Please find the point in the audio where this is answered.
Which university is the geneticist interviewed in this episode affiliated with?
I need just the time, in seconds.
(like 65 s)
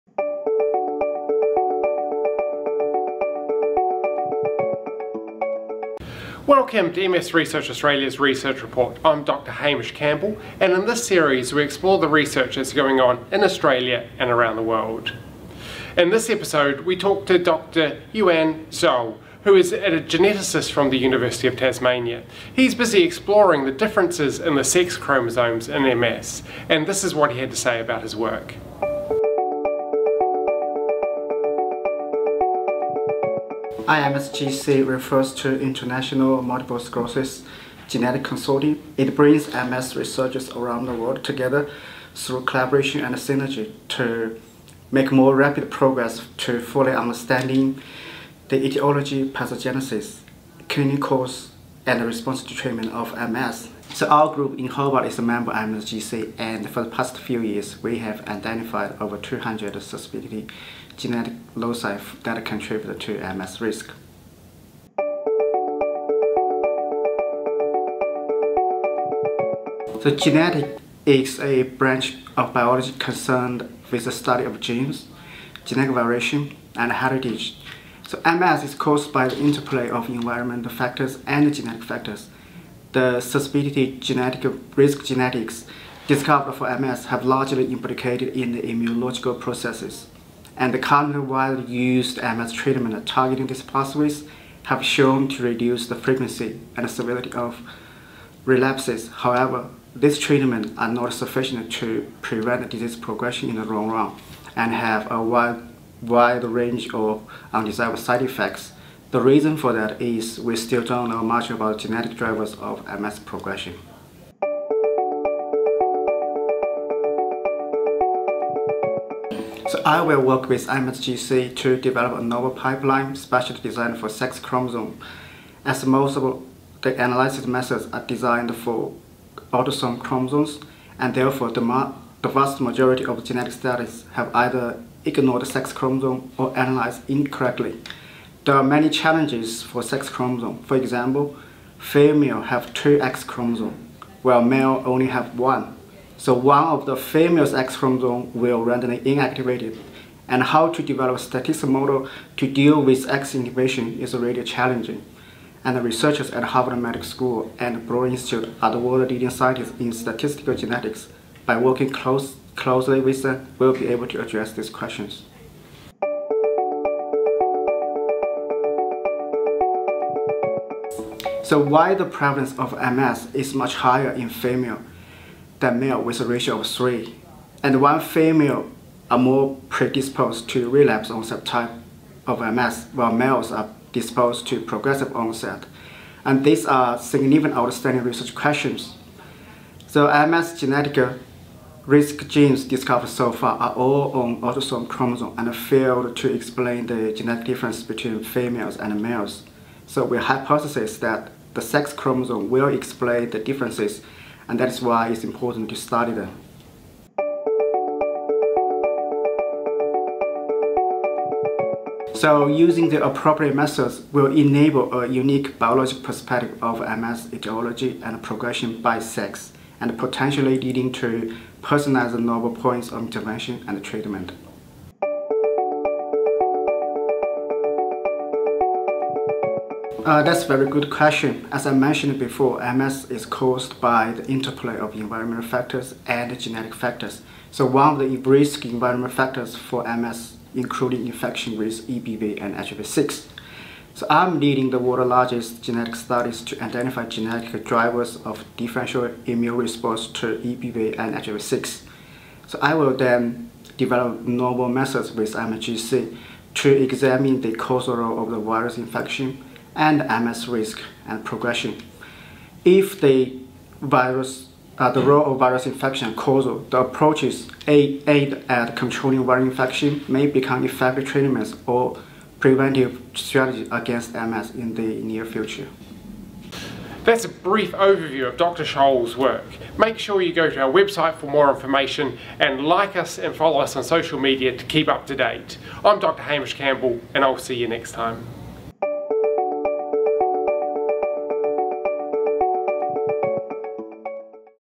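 20 s.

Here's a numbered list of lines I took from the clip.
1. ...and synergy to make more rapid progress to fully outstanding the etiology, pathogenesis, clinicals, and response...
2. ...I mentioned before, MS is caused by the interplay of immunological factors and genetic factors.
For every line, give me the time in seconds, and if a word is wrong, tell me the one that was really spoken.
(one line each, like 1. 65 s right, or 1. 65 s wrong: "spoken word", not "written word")
1. 43 s wrong: "understanding", not "outstanding"
2. 231 s wrong: "environmental", not "immunological".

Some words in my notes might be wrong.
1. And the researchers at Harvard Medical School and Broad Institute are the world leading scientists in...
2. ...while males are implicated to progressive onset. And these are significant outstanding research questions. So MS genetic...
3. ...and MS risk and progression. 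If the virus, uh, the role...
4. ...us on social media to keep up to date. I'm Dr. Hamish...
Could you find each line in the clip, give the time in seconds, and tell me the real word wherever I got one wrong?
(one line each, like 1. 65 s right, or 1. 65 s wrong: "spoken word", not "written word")
1. 155 s right
2. 182 s wrong: "disposed", not "implicated"
3. 259 s right
4. 283 s right.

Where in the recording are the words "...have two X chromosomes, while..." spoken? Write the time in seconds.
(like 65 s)
142 s.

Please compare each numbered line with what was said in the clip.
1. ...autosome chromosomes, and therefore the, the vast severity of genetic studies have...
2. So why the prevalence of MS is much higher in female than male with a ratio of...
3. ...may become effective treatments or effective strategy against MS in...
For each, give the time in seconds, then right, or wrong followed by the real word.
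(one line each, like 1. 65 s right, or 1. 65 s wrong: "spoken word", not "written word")
1. 129 s wrong: "majority", not "severity"
2. 171 s right
3. 270 s wrong: "preventive", not "effective".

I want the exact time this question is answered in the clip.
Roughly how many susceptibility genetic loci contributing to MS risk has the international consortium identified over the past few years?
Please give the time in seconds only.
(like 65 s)
58 s.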